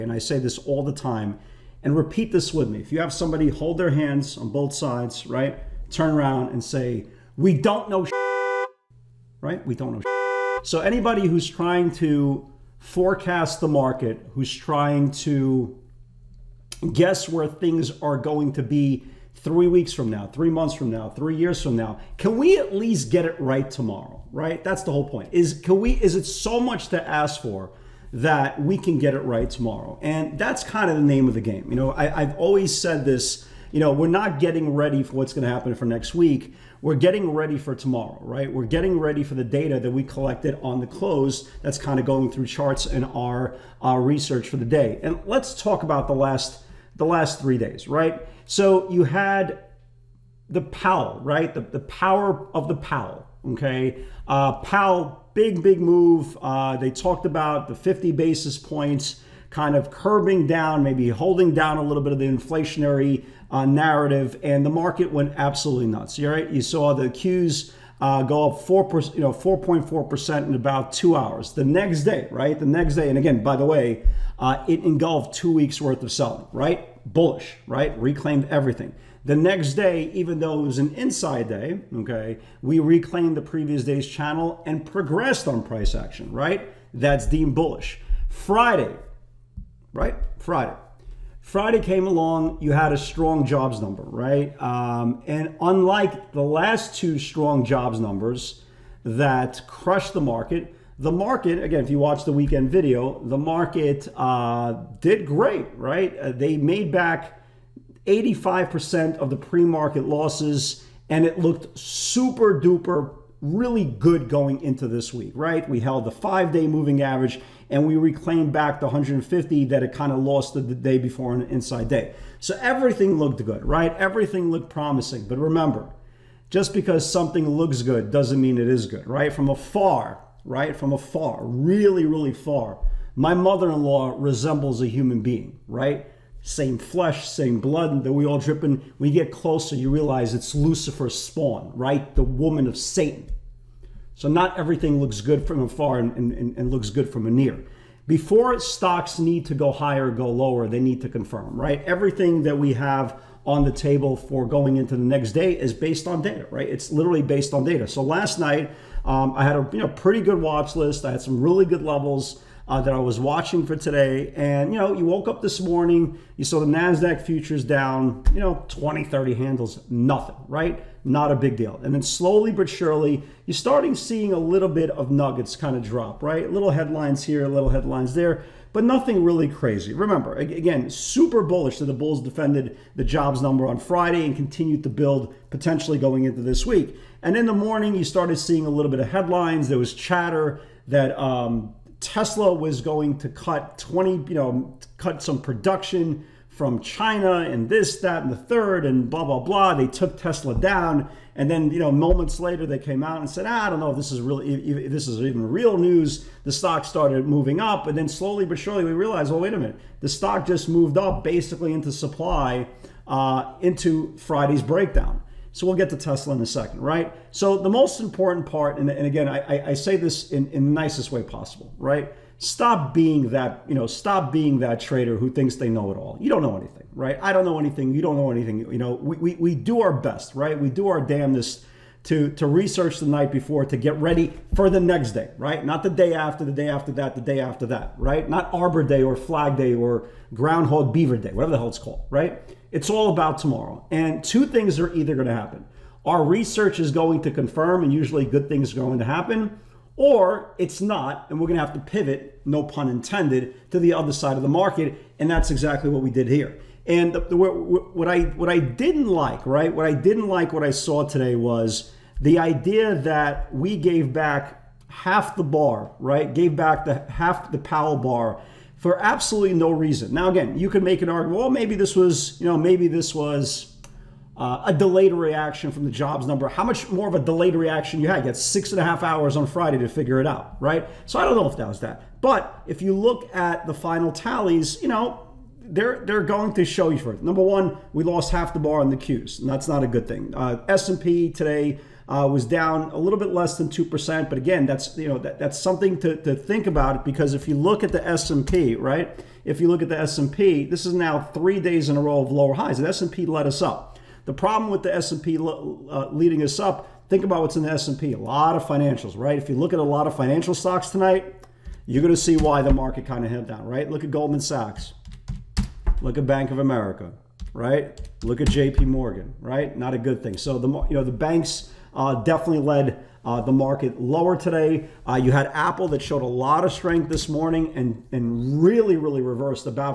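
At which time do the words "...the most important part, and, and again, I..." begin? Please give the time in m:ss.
3:37.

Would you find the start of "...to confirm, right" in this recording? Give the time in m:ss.
2:31.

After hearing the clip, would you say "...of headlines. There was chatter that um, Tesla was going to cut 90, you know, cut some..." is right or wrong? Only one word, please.
wrong.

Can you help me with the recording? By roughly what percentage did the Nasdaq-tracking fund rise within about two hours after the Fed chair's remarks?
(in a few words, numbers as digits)
4.4%.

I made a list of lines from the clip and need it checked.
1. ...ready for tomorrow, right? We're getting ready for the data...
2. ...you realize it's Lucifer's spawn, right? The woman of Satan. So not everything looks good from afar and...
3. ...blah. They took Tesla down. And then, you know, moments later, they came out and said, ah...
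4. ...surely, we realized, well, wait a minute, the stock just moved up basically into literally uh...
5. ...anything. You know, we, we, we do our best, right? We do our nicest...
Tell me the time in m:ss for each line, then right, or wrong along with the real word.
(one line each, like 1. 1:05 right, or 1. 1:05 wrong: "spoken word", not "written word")
1. 0:37 right
2. 2:19 right
3. 3:19 right
4. 3:28 wrong: "supply", not "literally"
5. 3:48 wrong: "damnedest", not "nicest".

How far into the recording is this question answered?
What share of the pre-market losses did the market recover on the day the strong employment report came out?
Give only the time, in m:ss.
1:48.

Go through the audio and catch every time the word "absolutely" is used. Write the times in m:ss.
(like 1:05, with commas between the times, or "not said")
1:05, 4:29.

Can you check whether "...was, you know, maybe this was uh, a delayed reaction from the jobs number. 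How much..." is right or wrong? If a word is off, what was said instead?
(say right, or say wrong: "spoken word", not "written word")
right.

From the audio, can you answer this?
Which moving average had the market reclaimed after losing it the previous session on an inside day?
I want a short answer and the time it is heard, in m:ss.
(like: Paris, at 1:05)
150, at 1:58.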